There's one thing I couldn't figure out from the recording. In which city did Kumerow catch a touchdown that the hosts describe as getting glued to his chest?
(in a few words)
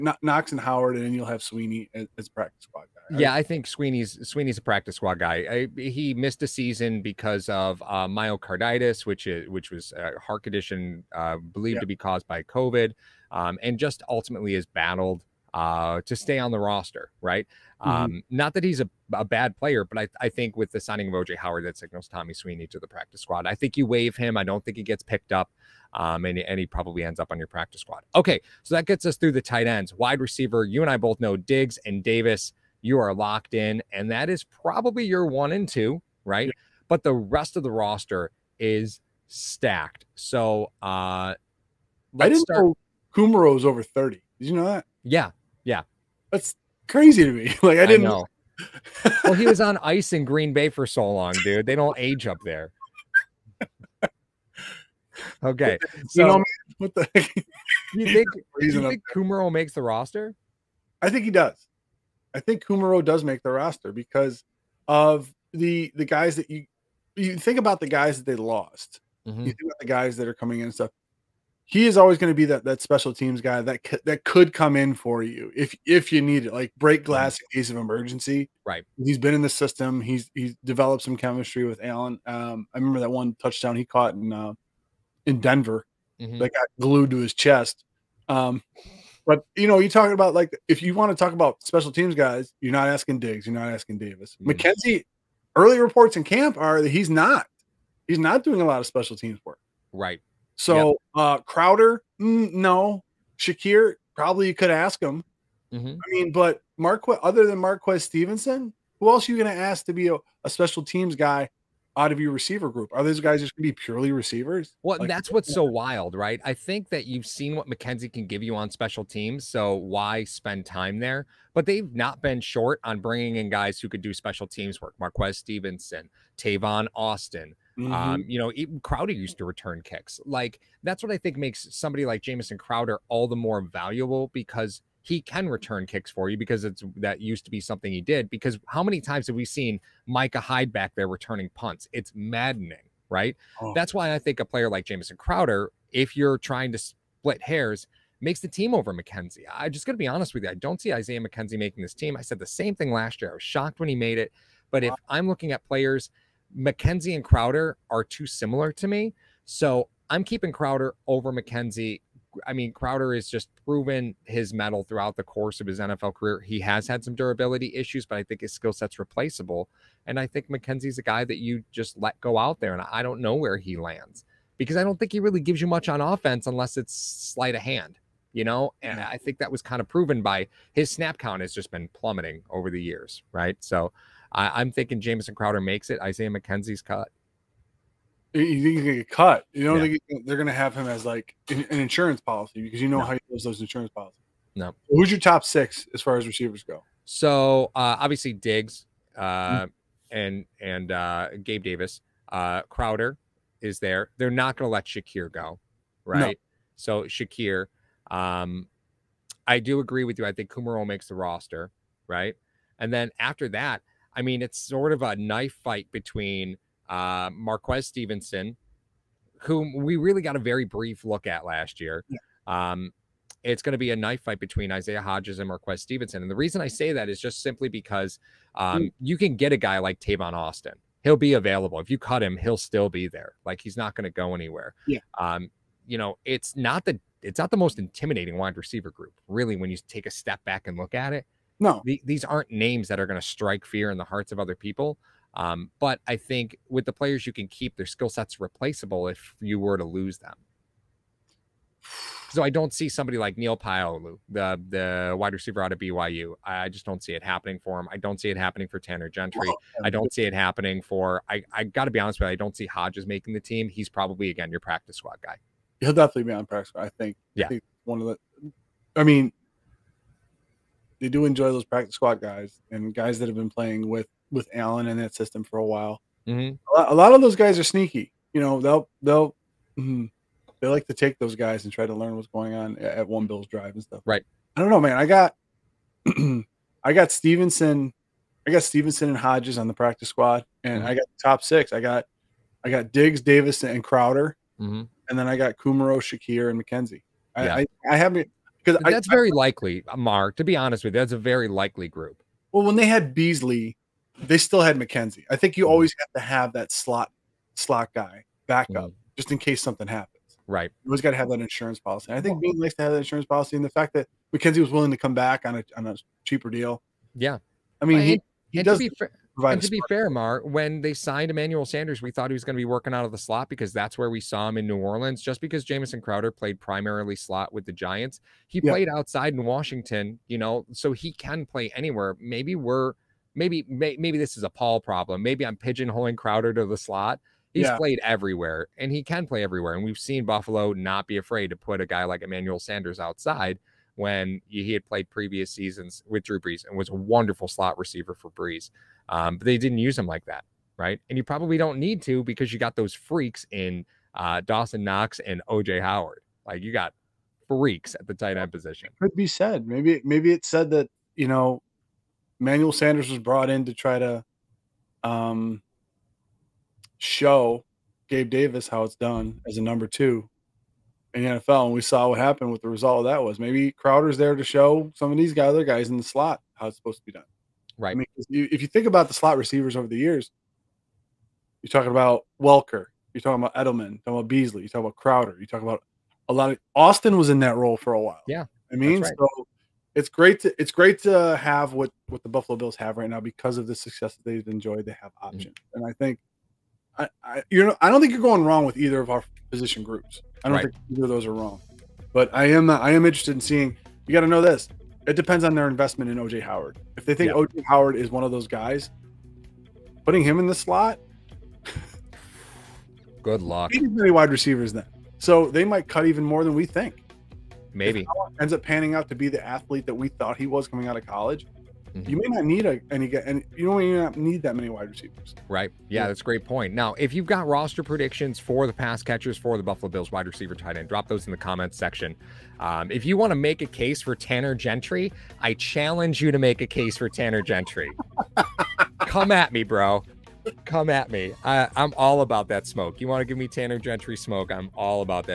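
Denver.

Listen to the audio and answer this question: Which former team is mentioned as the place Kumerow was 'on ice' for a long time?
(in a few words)
Green Bay.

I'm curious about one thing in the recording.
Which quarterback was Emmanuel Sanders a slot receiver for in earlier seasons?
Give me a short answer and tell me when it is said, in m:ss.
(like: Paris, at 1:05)
Drew Brees, at 5:46.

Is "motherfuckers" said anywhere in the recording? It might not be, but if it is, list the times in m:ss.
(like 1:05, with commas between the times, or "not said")
not said.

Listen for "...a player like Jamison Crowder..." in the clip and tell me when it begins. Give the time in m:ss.
2:24.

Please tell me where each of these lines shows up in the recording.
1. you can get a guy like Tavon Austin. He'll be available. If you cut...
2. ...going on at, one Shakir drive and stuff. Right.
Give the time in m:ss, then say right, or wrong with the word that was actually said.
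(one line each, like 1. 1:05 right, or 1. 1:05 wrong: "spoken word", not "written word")
1. 3:48 right
2. 4:42 wrong: "Bills", not "Shakir".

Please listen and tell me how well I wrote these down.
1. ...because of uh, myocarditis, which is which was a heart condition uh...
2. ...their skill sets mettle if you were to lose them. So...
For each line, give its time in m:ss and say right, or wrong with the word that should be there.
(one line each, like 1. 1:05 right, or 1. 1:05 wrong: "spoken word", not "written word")
1. 0:07 right
2. 4:07 wrong: "replaceable", not "mettle".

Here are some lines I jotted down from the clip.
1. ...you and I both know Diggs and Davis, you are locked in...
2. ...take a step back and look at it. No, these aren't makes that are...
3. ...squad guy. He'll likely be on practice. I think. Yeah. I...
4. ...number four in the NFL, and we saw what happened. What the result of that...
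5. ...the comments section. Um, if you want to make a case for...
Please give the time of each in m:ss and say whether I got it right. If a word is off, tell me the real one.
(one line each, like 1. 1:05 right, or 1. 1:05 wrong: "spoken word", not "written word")
1. 0:30 right
2. 3:59 wrong: "names", not "makes"
3. 4:24 wrong: "definitely", not "likely"
4. 6:09 wrong: "two", not "four"
5. 7:11 right.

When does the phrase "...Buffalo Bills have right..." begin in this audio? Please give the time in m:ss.
6:32.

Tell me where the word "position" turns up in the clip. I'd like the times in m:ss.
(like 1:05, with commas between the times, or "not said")
5:58, 6:39.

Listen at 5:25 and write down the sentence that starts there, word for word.
Just because Jamison Crowder played primarily slot with the Giants, he yeah.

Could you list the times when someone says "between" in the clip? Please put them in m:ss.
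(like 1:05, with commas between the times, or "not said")
3:35, 3:44.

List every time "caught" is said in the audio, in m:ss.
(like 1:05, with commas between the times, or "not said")
1:23.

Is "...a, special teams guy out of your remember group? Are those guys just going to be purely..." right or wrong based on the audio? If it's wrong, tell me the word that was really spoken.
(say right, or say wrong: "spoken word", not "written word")
wrong: "receiver", not "remember".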